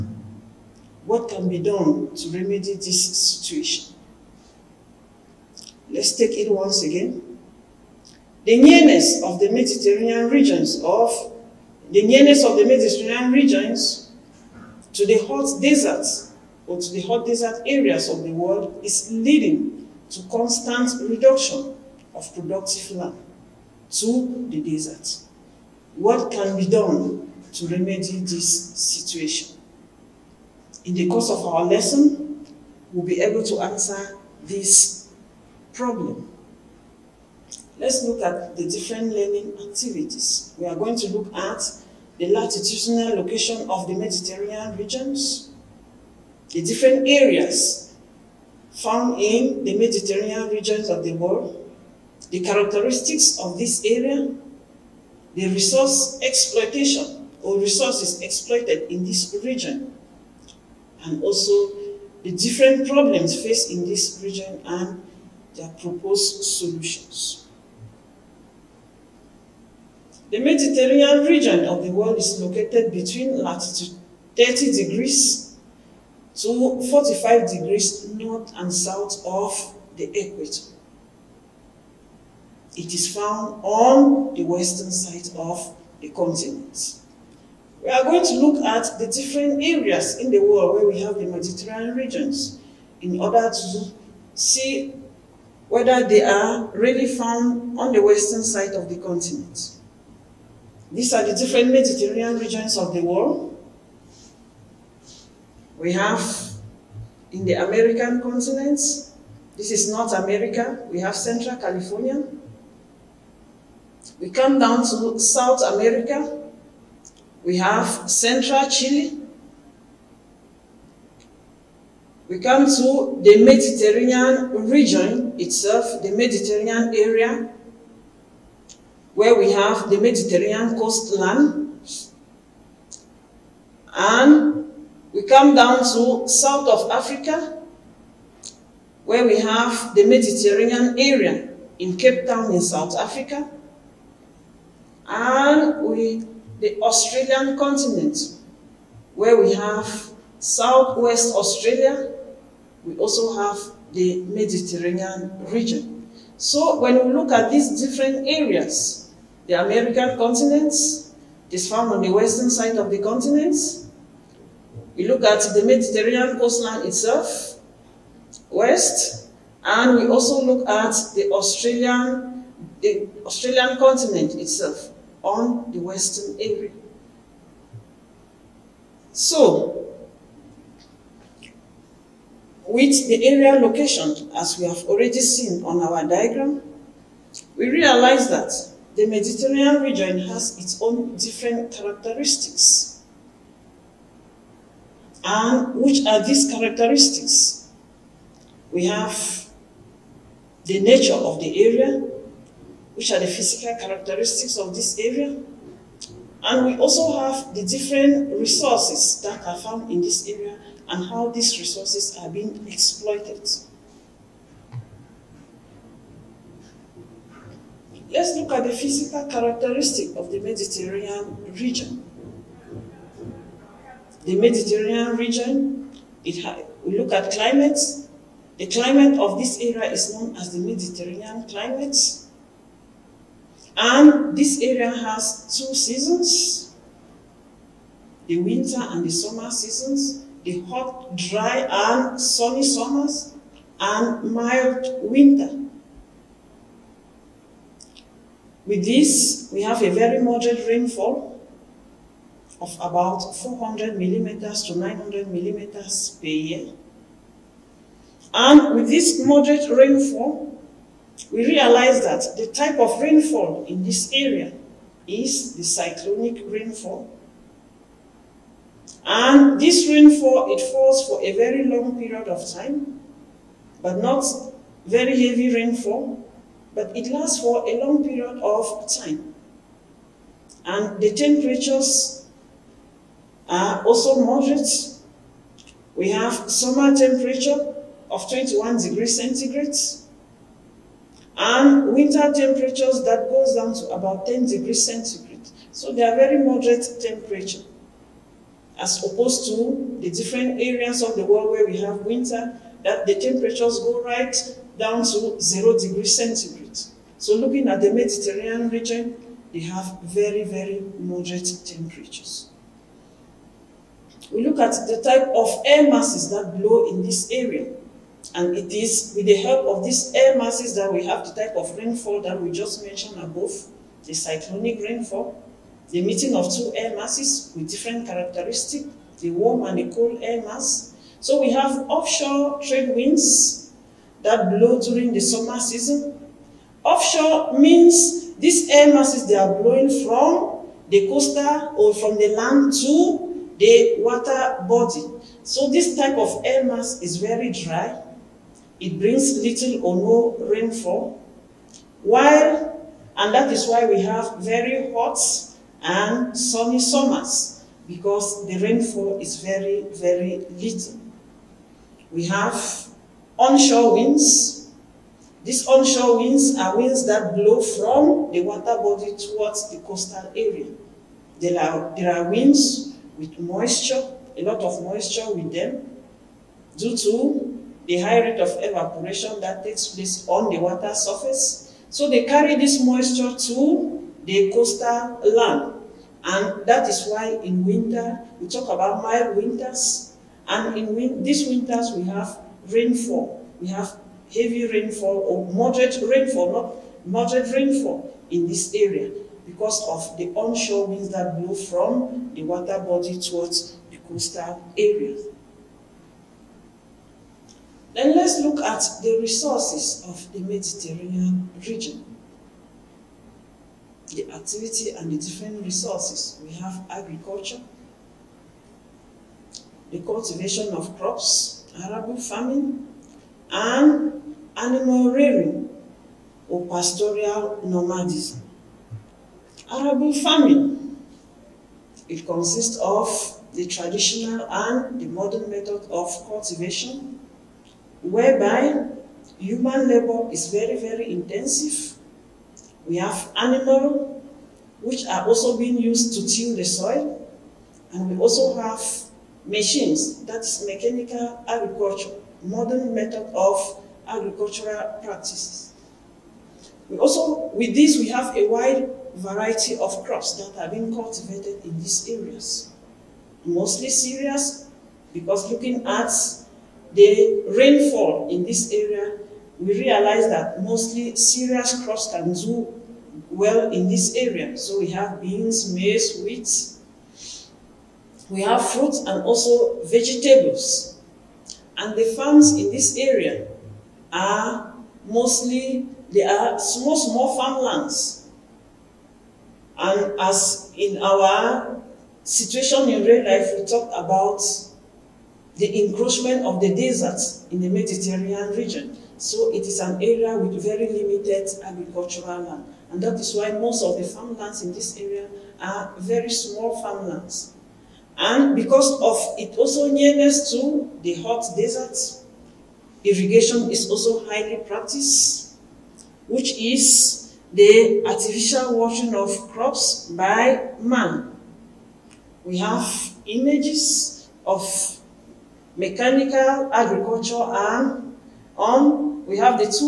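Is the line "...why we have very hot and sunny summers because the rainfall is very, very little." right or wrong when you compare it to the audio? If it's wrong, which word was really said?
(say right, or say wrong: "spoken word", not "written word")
right.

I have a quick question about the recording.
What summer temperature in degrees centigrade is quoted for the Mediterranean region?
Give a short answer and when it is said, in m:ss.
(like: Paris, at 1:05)
21 degrees, at 4:48.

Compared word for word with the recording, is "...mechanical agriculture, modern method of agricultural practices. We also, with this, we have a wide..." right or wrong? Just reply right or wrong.
right.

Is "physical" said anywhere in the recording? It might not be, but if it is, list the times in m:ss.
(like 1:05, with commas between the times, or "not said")
3:23, 3:38.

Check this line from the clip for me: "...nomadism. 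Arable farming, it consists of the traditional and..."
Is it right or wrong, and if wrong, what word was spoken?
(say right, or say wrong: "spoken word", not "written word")
right.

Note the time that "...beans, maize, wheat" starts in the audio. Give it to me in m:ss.
7:55.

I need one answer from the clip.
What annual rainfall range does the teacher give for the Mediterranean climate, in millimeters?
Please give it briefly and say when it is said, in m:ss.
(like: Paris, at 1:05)
400 to 900 mm, at 4:13.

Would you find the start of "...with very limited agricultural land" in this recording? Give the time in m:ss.
8:20.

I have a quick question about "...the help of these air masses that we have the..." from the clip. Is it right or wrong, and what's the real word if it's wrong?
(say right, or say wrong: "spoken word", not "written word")
right.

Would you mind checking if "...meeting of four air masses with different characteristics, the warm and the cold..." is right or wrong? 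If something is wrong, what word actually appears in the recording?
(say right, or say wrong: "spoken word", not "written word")
wrong: "two", not "four".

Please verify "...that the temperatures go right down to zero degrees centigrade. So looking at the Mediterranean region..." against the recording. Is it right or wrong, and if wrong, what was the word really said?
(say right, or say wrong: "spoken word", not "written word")
right.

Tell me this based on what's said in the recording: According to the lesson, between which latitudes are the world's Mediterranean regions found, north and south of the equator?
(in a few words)
30 to 45 degrees.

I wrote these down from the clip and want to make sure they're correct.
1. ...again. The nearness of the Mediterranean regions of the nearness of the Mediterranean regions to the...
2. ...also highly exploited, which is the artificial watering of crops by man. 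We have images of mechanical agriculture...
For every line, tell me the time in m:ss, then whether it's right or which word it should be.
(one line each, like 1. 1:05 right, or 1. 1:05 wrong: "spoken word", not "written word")
1. 0:06 right
2. 8:33 wrong: "practiced", not "exploited".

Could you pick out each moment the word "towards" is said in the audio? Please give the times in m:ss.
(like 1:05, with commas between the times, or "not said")
6:09, 6:43.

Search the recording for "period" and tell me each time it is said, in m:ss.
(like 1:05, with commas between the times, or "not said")
4:31, 4:38.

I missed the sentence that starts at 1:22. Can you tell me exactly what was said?
It is found on the western side of the continent.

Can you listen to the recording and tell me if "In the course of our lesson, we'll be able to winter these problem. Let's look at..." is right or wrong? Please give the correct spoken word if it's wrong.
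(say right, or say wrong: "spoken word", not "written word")
wrong: "answer", not "winter".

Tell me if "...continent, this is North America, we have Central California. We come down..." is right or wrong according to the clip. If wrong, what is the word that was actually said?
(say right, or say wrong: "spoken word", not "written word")
right.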